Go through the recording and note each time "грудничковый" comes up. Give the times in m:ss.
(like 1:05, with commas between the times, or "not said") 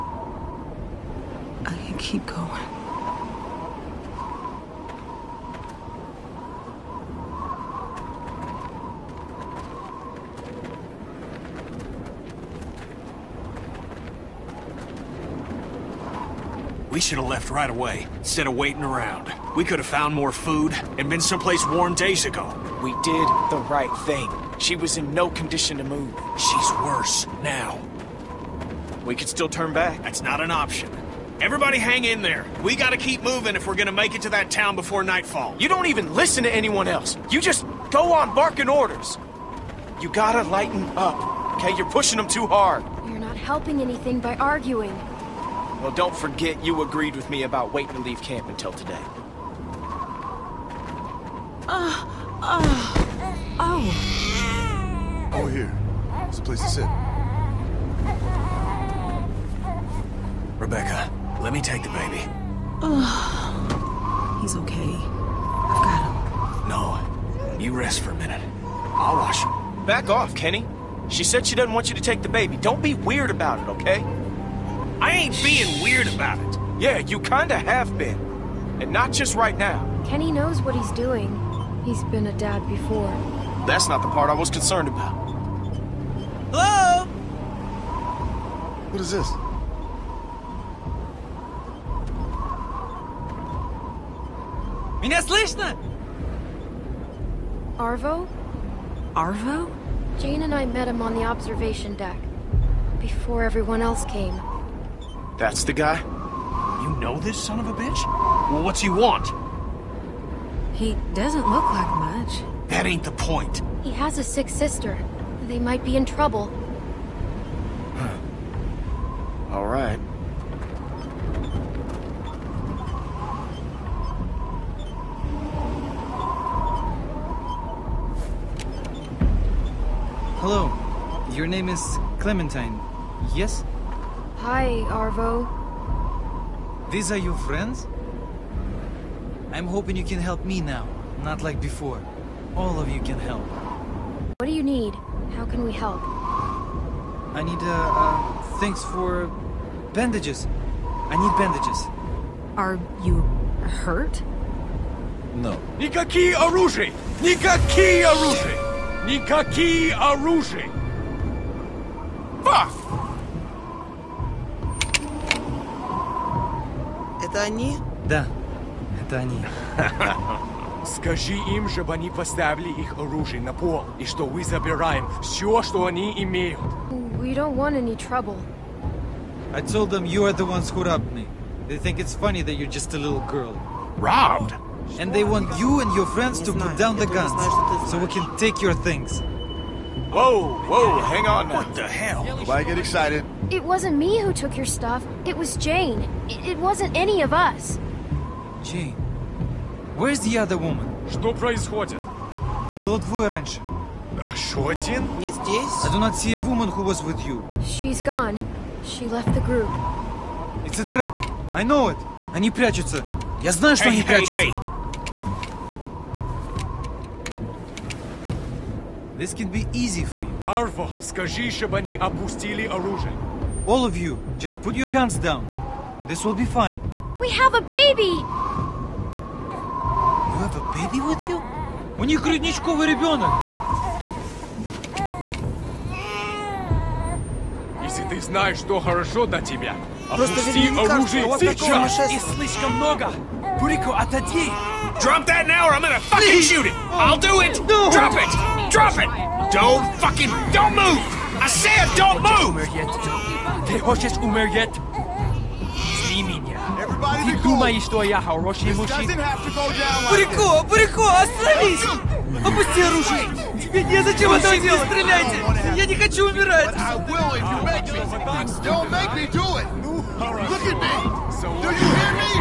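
3:52.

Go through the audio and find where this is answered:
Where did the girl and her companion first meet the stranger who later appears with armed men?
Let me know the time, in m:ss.
1:41.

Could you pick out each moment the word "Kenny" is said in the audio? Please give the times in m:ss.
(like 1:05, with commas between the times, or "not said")
1:10, 1:20.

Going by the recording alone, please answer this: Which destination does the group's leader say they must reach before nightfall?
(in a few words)
that town.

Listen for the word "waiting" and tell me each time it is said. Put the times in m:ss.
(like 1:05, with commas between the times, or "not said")
0:18, 0:47.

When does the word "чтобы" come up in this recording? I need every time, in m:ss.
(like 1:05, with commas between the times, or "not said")
2:51, 3:41.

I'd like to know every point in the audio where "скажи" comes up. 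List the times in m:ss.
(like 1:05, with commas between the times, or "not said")
2:50, 3:41.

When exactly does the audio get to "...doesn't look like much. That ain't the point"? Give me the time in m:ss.
1:51.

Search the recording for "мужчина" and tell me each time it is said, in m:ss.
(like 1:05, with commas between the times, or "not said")
4:18.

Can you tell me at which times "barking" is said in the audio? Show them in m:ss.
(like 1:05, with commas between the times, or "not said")
0:38.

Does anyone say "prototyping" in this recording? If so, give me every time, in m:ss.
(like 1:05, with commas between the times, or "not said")
not said.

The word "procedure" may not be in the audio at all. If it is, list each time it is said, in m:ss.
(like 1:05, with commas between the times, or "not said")
not said.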